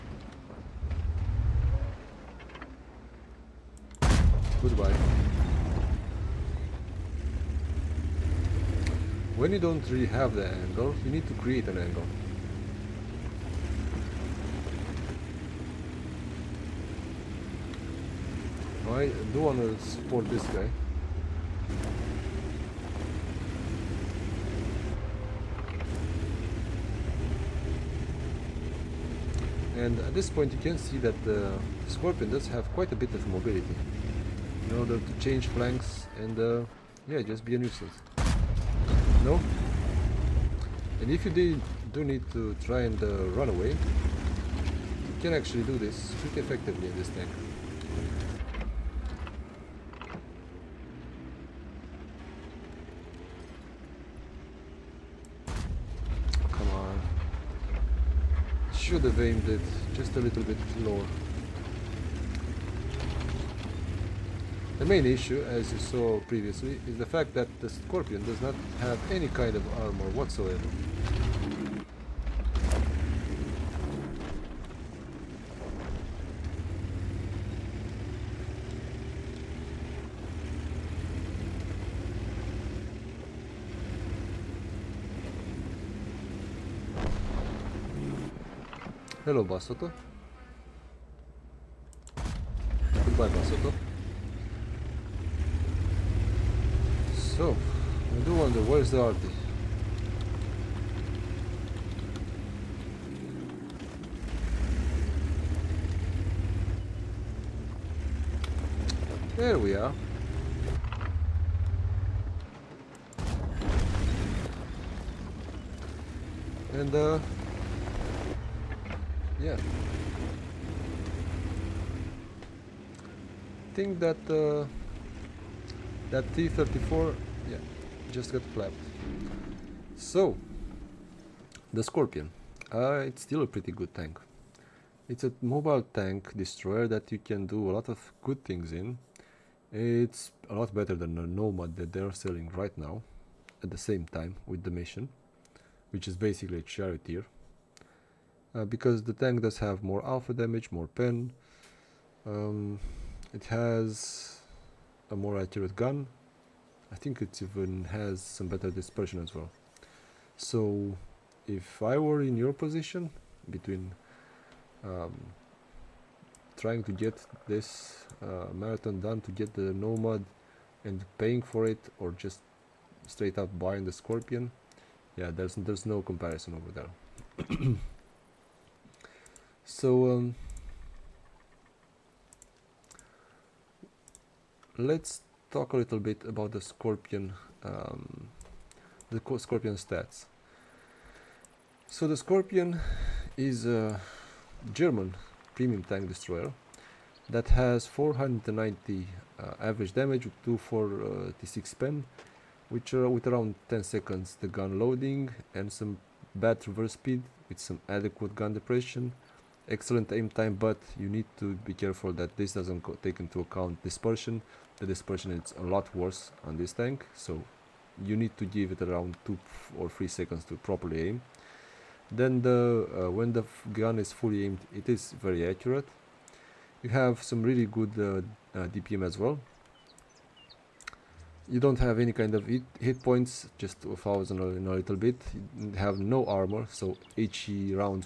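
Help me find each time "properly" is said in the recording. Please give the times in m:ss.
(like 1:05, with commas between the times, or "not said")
3:40.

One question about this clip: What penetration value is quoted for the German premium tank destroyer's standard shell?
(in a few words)
246.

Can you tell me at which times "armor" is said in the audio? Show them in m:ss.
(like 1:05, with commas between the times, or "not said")
1:09, 3:56.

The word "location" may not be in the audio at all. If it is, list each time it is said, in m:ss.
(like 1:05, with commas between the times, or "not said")
not said.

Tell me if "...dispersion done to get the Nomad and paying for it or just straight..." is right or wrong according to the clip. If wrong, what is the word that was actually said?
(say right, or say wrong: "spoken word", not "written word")
wrong: "marathon", not "dispersion".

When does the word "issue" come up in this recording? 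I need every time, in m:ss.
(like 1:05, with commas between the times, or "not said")
1:05.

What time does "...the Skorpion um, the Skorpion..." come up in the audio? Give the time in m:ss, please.
3:06.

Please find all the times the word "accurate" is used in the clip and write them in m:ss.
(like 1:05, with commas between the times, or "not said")
2:35, 3:45.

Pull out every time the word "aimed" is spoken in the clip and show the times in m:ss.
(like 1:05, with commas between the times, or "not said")
0:59, 3:44.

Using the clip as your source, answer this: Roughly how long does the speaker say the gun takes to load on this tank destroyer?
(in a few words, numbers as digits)
10 seconds.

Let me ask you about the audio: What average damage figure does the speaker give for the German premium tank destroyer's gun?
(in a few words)
490.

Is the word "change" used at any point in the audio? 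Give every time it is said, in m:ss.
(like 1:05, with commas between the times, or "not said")
0:35.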